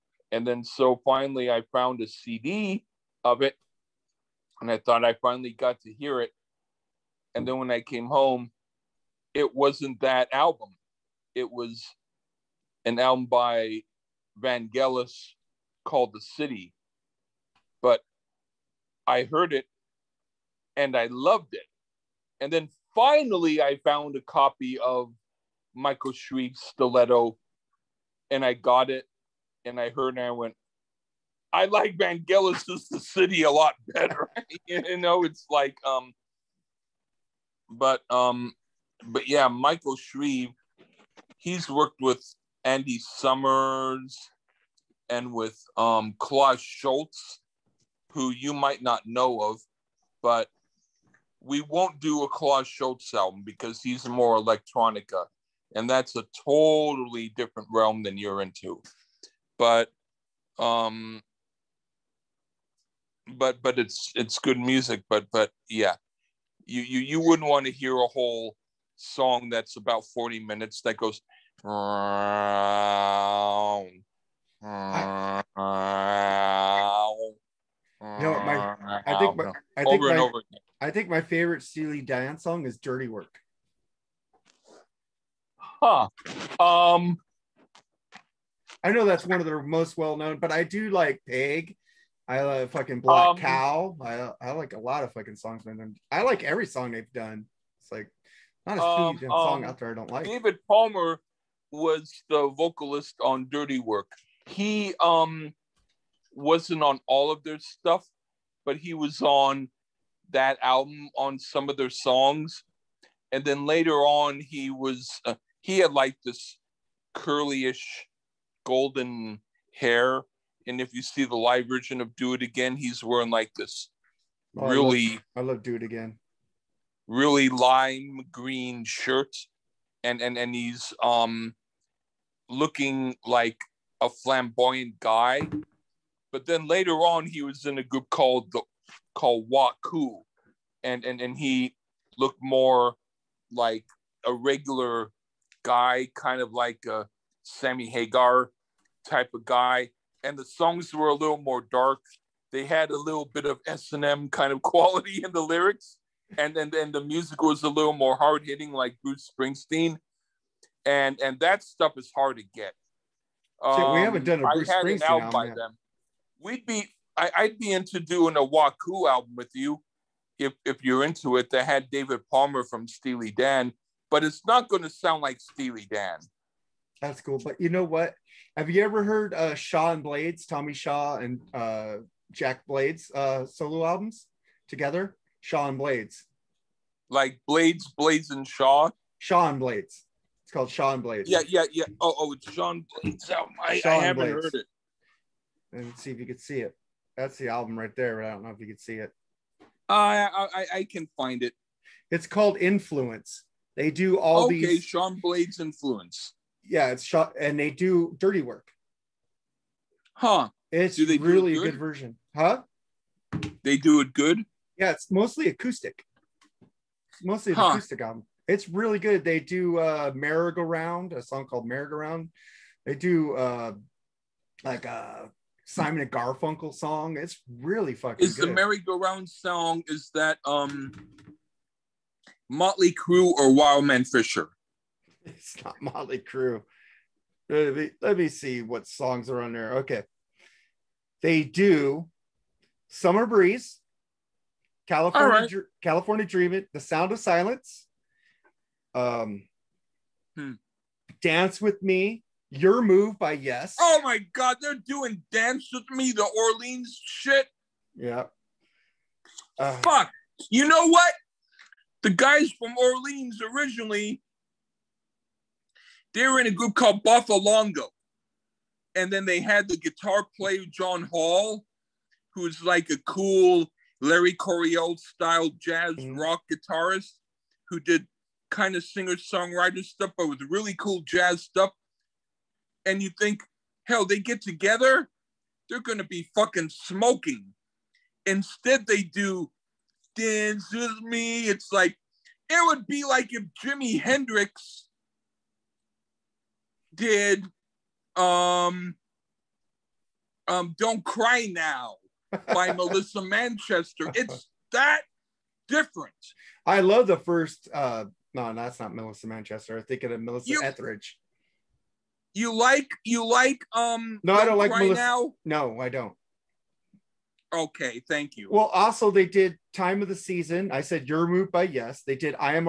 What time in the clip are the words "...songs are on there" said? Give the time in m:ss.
3:58.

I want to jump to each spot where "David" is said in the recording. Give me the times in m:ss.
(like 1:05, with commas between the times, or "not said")
1:40, 2:51.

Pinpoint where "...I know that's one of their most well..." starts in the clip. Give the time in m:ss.
1:28.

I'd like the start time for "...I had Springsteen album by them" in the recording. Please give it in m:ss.
2:44.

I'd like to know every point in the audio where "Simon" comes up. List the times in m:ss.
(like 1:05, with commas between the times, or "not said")
3:45.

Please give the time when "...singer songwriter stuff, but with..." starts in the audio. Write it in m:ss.
4:38.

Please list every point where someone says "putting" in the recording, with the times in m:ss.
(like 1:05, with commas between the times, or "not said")
not said.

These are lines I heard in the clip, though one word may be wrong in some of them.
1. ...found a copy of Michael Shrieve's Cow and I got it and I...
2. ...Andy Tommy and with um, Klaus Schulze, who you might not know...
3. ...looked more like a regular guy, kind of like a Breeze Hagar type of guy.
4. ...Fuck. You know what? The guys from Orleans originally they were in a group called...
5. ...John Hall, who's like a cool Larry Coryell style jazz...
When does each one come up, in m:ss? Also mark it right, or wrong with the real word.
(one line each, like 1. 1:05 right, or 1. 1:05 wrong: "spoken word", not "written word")
1. 0:23 wrong: "Stiletto", not "Cow"
2. 0:42 wrong: "Summers", not "Tommy"
3. 2:22 wrong: "Sammy", not "Breeze"
4. 4:19 right
5. 4:30 right.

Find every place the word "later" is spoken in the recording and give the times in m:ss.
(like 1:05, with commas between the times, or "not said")
1:53, 2:16.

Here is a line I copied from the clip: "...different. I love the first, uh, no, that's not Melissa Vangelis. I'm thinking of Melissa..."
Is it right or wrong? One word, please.
wrong.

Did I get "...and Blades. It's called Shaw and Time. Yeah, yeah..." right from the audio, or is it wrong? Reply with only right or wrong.
wrong.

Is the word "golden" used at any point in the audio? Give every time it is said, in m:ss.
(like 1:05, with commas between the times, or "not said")
1:58.